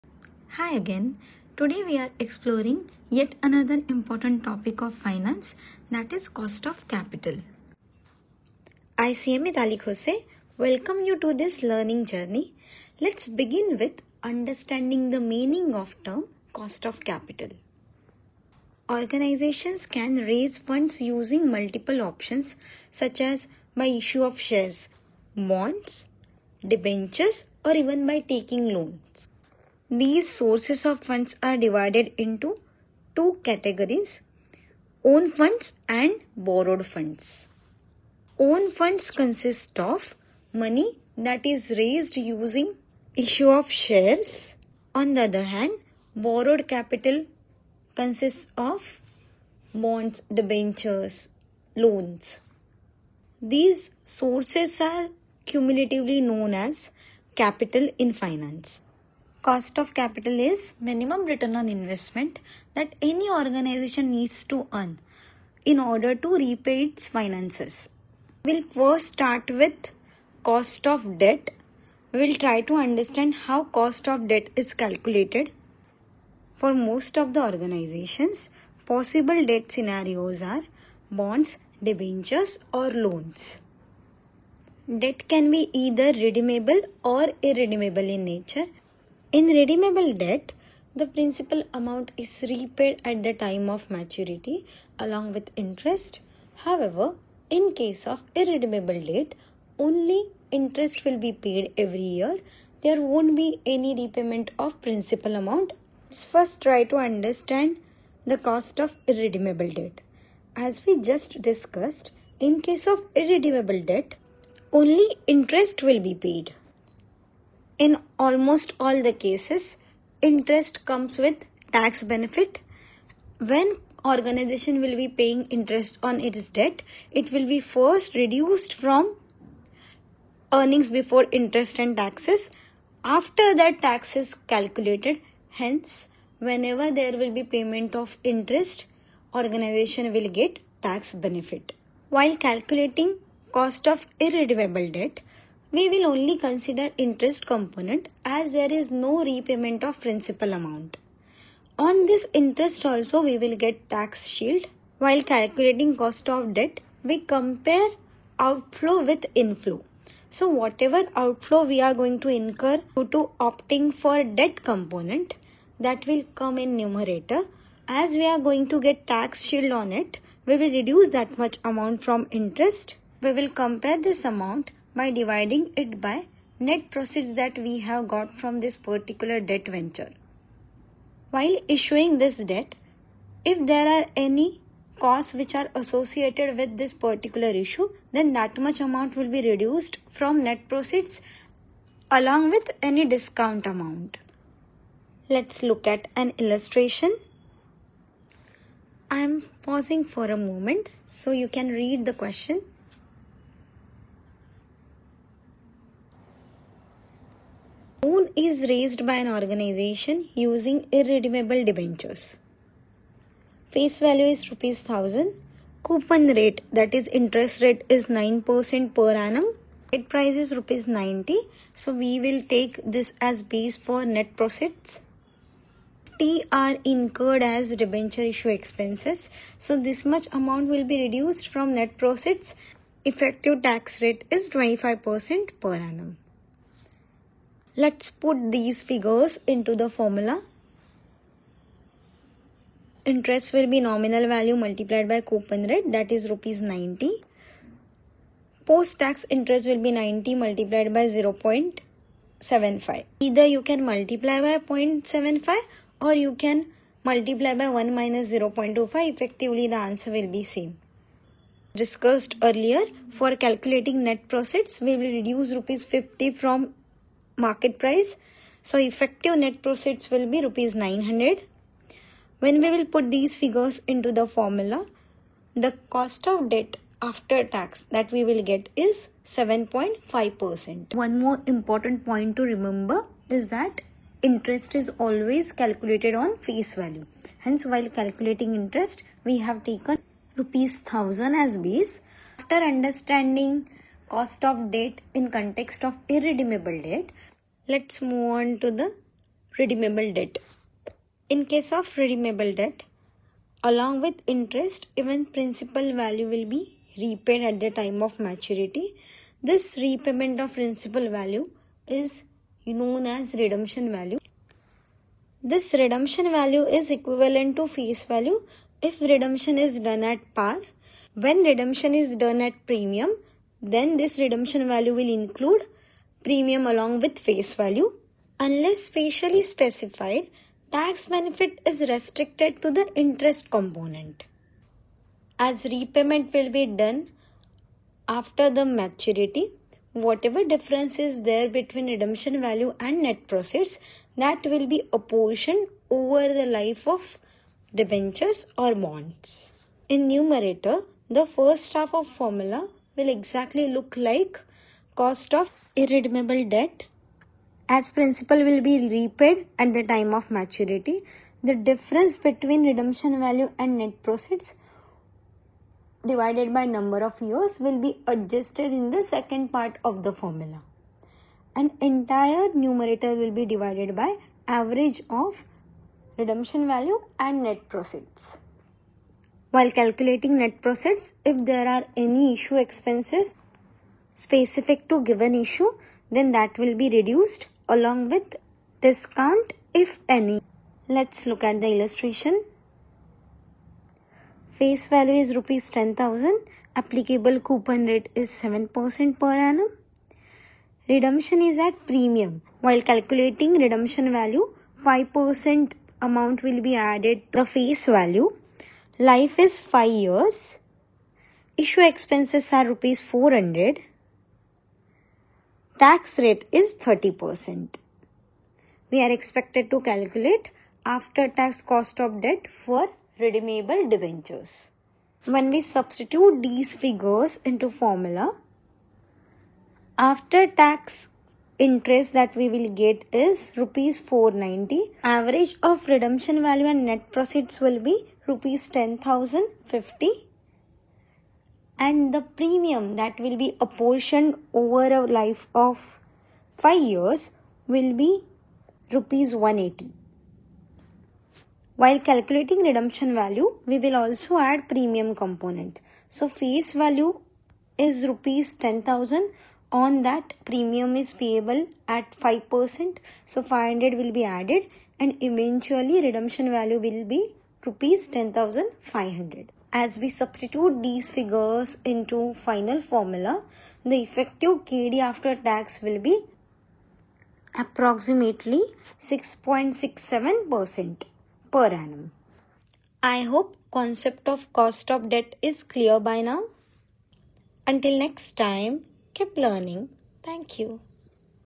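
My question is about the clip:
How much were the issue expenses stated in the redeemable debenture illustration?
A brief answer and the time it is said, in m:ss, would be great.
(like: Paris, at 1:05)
Rs 400, at 6:52.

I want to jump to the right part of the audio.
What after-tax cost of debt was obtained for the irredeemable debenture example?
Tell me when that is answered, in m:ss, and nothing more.
4:39.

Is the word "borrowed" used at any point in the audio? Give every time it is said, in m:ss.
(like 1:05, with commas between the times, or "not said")
0:36, 0:46.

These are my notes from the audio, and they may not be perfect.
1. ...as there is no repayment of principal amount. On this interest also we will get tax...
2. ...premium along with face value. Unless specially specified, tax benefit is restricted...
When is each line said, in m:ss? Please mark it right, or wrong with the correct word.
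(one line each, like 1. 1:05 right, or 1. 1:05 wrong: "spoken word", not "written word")
1. 2:28 right
2. 5:26 right.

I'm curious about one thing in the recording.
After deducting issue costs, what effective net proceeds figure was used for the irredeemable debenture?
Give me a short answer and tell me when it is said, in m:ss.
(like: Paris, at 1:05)
Rs 900, at 4:30.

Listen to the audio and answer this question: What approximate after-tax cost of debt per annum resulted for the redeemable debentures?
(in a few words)
6.67%.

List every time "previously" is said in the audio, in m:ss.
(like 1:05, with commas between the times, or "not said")
not said.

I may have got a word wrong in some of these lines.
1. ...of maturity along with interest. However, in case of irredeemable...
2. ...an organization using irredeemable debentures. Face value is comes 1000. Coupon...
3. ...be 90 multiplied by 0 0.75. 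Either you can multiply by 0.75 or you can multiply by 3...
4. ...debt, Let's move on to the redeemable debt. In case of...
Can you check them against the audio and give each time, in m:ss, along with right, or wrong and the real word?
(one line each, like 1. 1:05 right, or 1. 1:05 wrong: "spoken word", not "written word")
1. 1:33 right
2. 3:29 wrong: "rupees", not "comes"
3. 4:09 wrong: "1", not "3"
4. 4:56 right.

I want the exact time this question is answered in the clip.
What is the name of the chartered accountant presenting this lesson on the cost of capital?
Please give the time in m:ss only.
0:09.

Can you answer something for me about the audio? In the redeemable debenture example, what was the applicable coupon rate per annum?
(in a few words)
7%.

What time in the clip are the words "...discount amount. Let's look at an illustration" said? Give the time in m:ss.
3:13.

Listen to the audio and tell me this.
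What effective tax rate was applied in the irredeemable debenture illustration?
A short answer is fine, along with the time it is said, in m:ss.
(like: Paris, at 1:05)
25%, at 3:54.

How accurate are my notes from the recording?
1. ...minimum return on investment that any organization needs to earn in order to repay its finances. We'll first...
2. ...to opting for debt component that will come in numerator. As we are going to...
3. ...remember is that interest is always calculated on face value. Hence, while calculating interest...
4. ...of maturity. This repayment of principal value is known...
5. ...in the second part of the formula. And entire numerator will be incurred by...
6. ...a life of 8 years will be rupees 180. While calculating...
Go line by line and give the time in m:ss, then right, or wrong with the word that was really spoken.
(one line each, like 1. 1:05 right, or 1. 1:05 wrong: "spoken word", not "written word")
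1. 1:00 right
2. 2:43 right
3. 4:42 right
4. 5:08 right
5. 6:08 wrong: "divided", not "incurred"
6. 7:24 wrong: "5", not "8".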